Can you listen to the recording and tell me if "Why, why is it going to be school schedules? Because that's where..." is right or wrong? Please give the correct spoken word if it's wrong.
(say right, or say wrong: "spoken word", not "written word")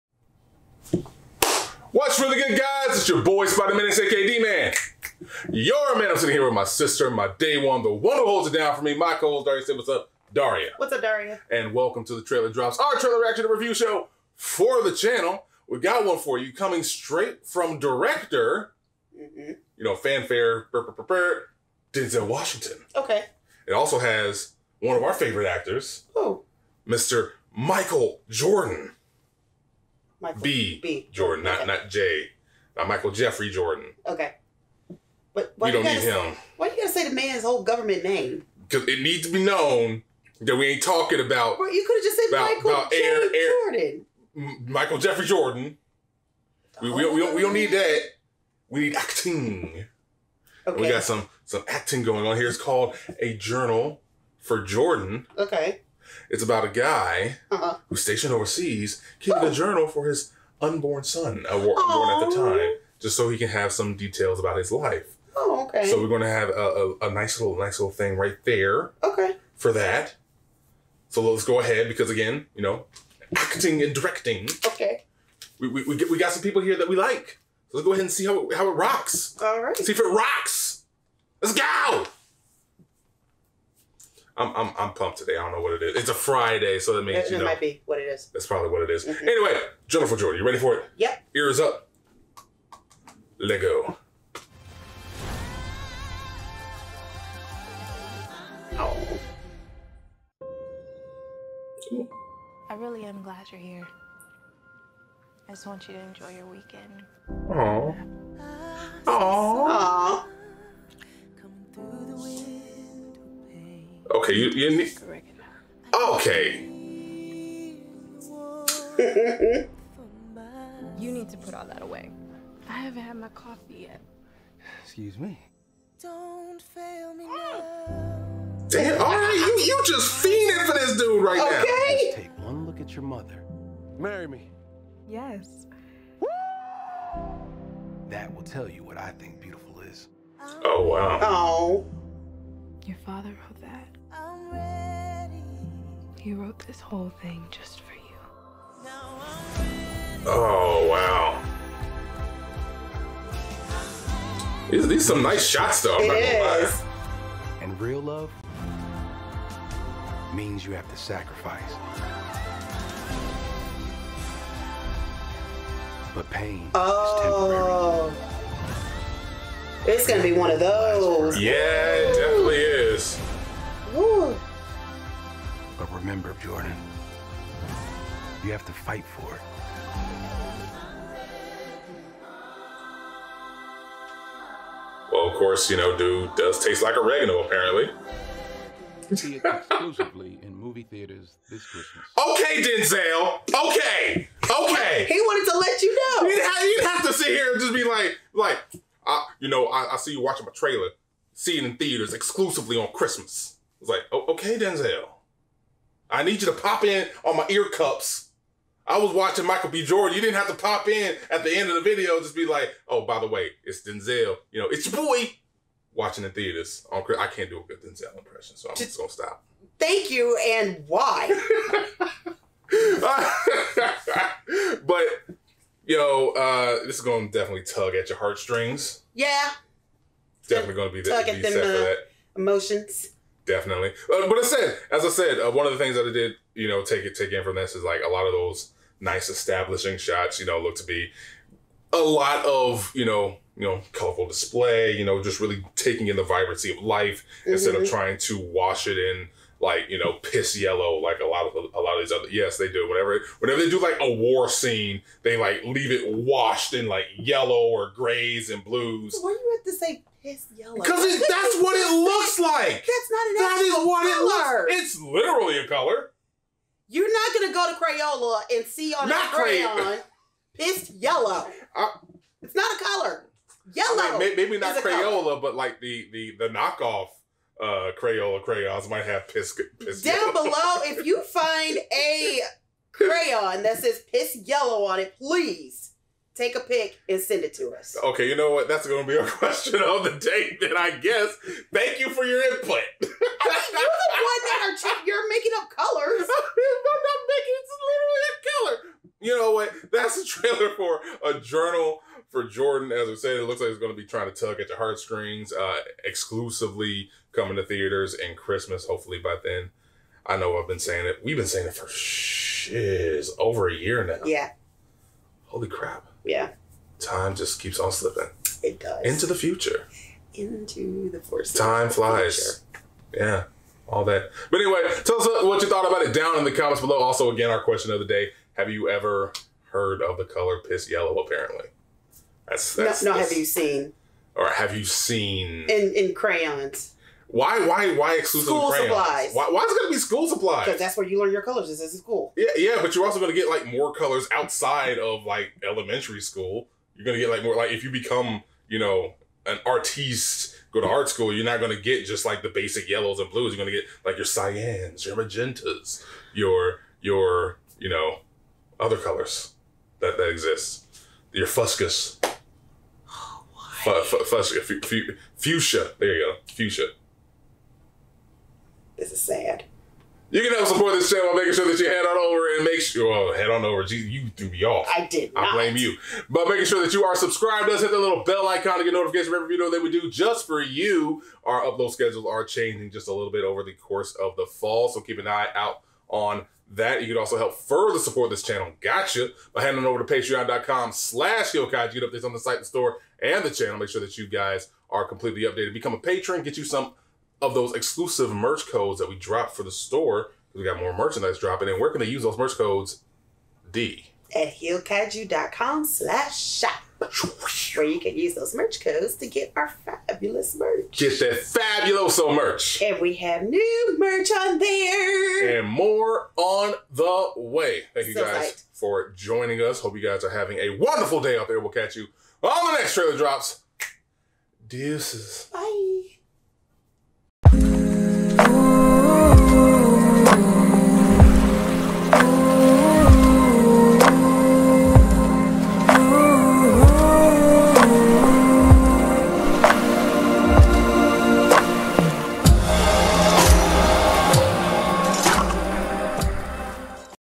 wrong: "supplies", not "schedules".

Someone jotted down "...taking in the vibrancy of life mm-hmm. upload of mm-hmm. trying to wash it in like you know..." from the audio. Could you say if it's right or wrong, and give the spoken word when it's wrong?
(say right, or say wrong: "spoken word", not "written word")
wrong: "instead", not "upload".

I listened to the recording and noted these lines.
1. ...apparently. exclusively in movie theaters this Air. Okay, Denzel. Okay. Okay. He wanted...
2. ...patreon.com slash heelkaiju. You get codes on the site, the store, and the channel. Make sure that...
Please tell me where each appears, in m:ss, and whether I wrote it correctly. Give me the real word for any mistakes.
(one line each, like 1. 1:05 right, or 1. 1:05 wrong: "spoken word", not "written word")
1. 3:07 wrong: "Christmas", not "Air"
2. 6:30 wrong: "updates", not "codes".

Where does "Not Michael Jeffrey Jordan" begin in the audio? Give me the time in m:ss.
0:32.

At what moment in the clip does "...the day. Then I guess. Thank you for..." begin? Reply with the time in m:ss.
4:50.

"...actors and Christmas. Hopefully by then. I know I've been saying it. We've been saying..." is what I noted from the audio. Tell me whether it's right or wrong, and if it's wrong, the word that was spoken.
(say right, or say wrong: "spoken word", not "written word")
wrong: "theaters", not "actors".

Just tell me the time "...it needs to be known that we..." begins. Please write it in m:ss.
0:38.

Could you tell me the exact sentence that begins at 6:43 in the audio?
D at heelkaiju.com slash shop where you can use those merch codes to get our fabulous merch.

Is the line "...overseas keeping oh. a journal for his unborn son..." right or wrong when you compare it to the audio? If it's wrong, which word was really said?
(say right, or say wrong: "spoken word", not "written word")
right.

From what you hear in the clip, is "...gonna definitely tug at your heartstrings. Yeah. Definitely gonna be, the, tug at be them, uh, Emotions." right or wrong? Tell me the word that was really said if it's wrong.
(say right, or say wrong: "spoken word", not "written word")
right.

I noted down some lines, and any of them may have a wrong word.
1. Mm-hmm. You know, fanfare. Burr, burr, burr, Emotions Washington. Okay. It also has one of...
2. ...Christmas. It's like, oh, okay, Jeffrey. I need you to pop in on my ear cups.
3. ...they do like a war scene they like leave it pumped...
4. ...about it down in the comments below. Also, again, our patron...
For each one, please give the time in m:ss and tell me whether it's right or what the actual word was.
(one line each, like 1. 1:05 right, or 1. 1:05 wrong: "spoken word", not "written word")
1. 0:19 wrong: "Denzel", not "Emotions"
2. 3:22 wrong: "Denzel", not "Jeffrey"
3. 4:13 wrong: "washed", not "pumped"
4. 5:25 wrong: "question", not "patron".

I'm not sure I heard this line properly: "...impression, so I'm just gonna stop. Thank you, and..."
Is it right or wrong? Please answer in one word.
right.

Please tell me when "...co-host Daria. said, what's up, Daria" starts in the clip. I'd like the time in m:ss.
0:09.